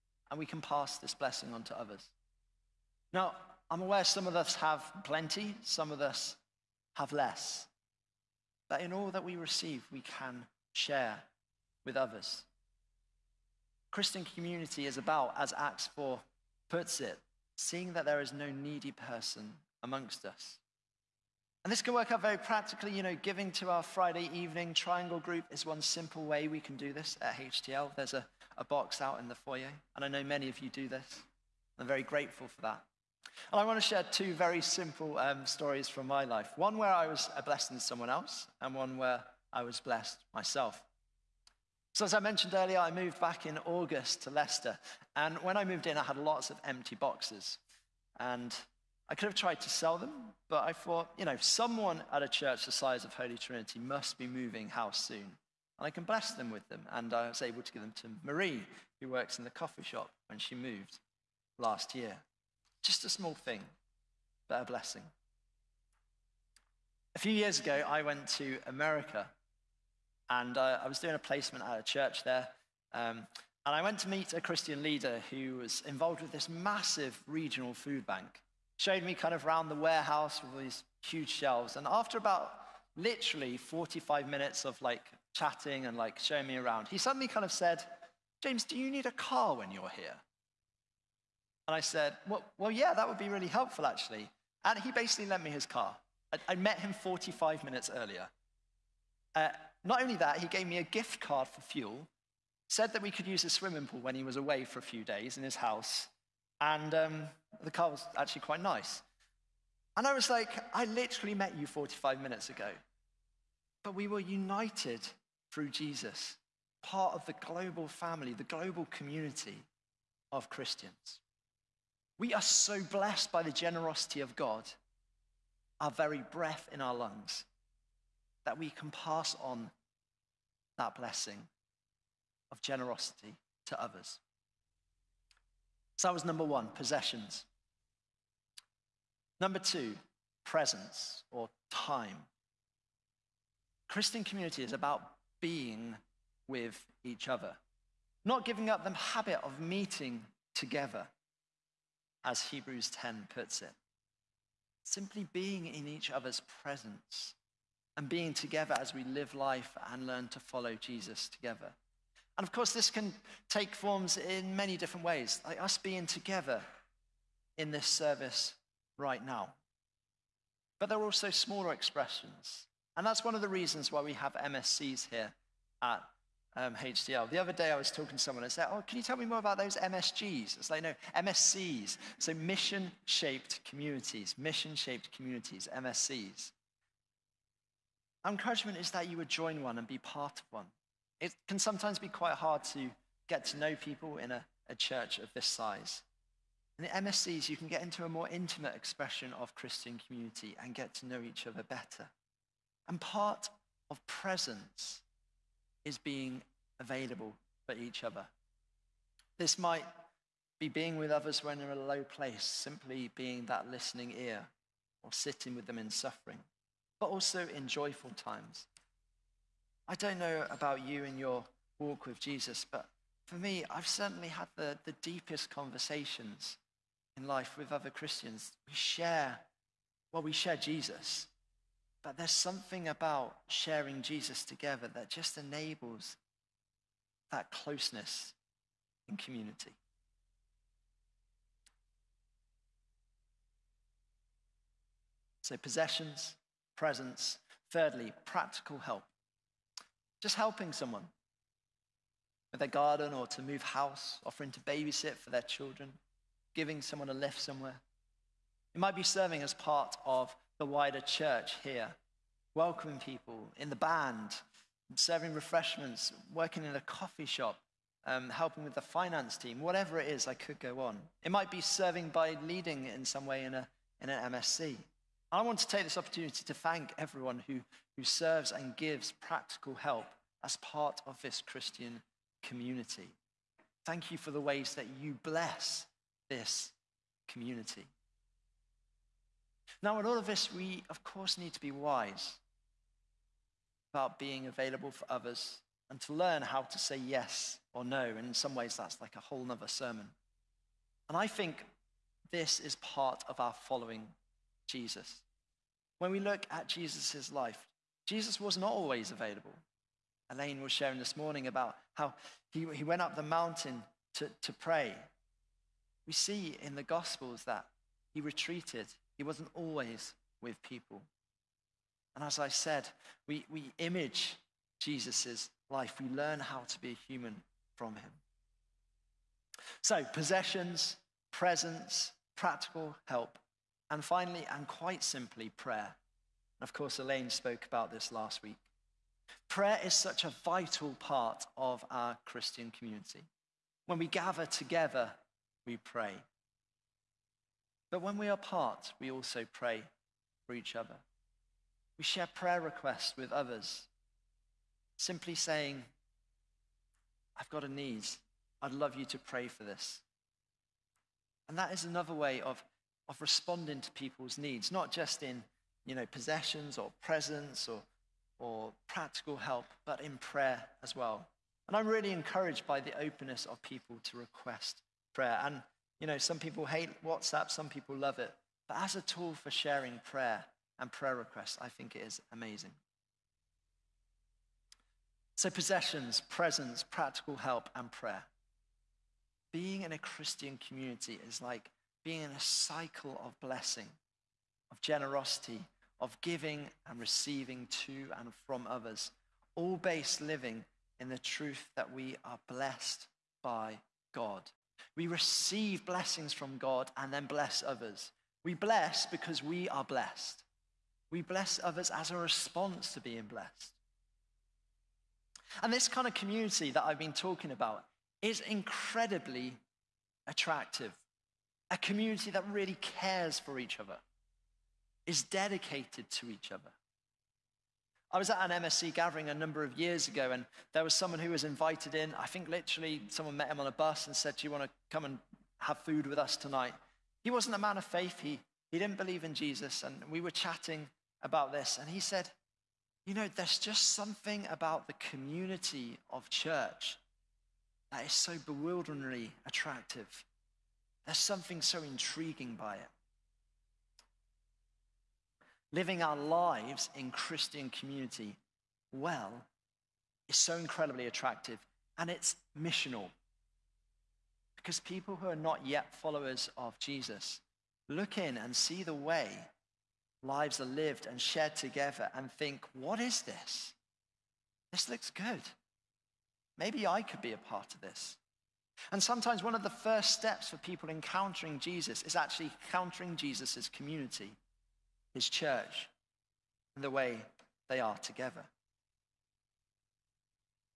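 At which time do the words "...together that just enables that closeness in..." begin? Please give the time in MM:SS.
03:54.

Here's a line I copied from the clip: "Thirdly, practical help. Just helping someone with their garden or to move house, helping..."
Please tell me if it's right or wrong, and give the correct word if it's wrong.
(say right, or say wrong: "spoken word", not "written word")
wrong: "offering", not "helping".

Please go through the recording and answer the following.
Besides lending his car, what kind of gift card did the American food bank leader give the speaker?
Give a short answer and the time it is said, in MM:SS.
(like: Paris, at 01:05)
fuel, at 01:40.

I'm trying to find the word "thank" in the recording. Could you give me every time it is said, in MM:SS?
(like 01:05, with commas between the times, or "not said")
04:36, 04:43.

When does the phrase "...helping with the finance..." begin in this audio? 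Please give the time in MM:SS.
04:28.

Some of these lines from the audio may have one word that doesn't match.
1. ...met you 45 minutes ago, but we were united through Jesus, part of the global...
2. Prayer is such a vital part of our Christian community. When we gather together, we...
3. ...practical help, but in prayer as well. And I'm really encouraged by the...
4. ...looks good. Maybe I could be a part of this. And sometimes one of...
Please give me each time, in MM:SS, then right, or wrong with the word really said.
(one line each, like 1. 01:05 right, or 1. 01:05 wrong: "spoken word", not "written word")
1. 01:51 right
2. 05:39 right
3. 06:08 right
4. 07:54 right.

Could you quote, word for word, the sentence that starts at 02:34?
Simply being in each other's presence and being together as we live life and learn to follow Jesus together.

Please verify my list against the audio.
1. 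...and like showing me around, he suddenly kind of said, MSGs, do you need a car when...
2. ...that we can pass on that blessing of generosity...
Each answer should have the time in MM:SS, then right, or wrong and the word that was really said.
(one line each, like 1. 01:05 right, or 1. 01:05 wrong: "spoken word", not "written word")
1. 01:25 wrong: "James", not "MSGs"
2. 02:08 right.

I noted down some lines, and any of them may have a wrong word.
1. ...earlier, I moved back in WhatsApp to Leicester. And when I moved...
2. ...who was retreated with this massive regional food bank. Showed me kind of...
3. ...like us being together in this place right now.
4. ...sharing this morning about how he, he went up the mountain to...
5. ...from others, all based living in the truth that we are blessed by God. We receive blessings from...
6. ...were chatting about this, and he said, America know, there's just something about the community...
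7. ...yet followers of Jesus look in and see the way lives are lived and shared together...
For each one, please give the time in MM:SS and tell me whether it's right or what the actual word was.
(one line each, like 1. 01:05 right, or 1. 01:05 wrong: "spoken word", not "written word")
1. 00:42 wrong: "August", not "WhatsApp"
2. 01:15 wrong: "involved", not "retreated"
3. 02:45 wrong: "service", not "place"
4. 05:10 right
5. 06:38 right
6. 07:20 wrong: "You", not "America"
7. 07:45 right.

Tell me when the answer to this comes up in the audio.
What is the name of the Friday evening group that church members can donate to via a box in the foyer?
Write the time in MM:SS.
00:24.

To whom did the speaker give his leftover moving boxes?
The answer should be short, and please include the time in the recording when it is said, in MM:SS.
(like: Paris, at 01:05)
Marie, at 00:58.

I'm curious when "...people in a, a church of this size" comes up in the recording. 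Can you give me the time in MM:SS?
03:13.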